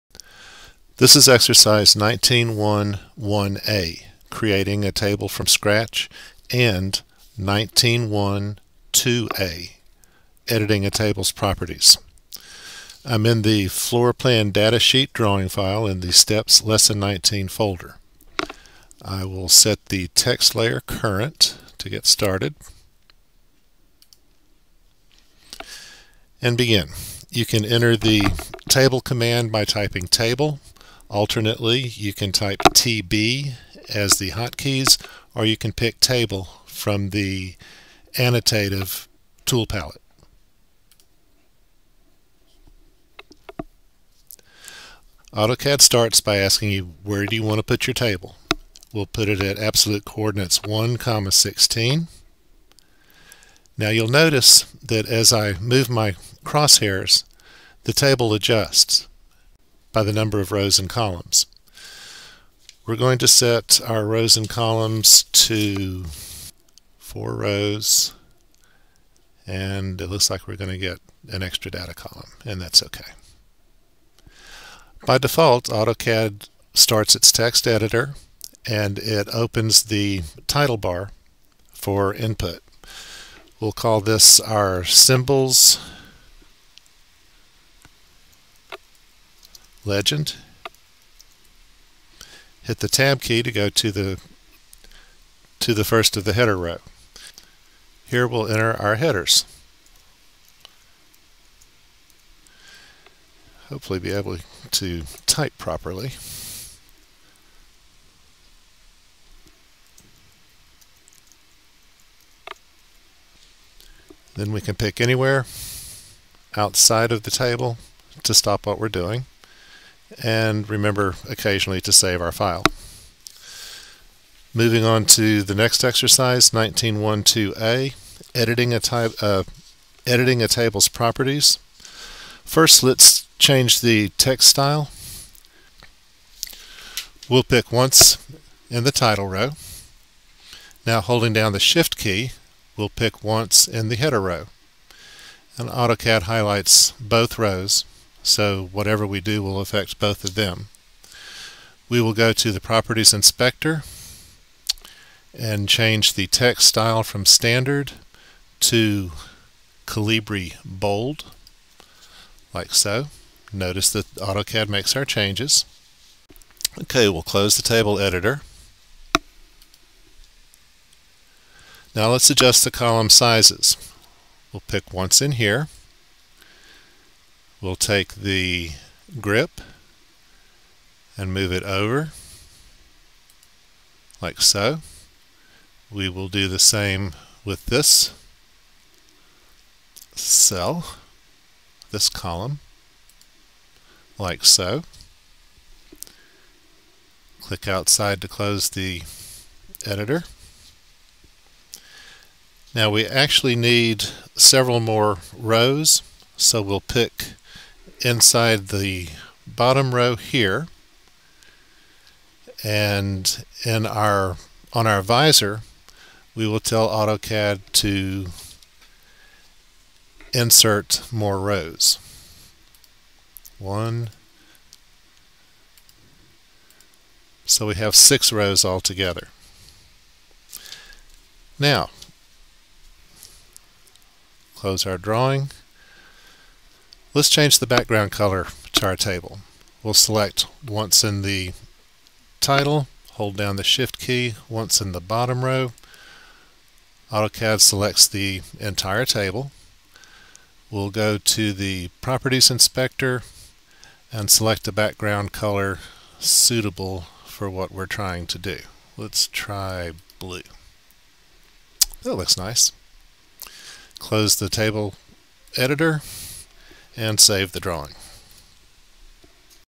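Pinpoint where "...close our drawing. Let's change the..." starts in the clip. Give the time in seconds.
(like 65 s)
234 s.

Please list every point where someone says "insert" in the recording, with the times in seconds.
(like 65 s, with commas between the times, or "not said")
220 s.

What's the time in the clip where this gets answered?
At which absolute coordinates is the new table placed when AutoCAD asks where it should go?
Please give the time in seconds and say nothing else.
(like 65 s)
50 s.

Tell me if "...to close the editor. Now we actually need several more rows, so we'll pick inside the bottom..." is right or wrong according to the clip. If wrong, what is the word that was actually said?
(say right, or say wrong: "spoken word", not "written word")
right.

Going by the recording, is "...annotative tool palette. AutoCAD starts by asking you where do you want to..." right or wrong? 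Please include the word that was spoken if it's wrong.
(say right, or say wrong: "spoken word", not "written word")
right.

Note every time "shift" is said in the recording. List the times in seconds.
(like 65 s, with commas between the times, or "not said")
141 s, 243 s.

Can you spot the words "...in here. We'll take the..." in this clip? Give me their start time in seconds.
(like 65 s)
175 s.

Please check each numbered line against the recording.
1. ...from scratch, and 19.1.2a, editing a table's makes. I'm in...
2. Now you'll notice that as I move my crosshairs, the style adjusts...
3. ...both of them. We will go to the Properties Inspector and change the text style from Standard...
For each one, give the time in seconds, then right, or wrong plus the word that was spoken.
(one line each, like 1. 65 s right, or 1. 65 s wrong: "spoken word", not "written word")
1. 5 s wrong: "properties", not "makes"
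2. 53 s wrong: "table", not "style"
3. 149 s right.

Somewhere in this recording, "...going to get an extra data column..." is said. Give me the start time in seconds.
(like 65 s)
70 s.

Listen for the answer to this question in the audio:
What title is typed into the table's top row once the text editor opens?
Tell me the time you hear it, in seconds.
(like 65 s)
84 s.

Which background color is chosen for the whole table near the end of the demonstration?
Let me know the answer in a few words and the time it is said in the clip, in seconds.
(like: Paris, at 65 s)
Blue, at 260 s.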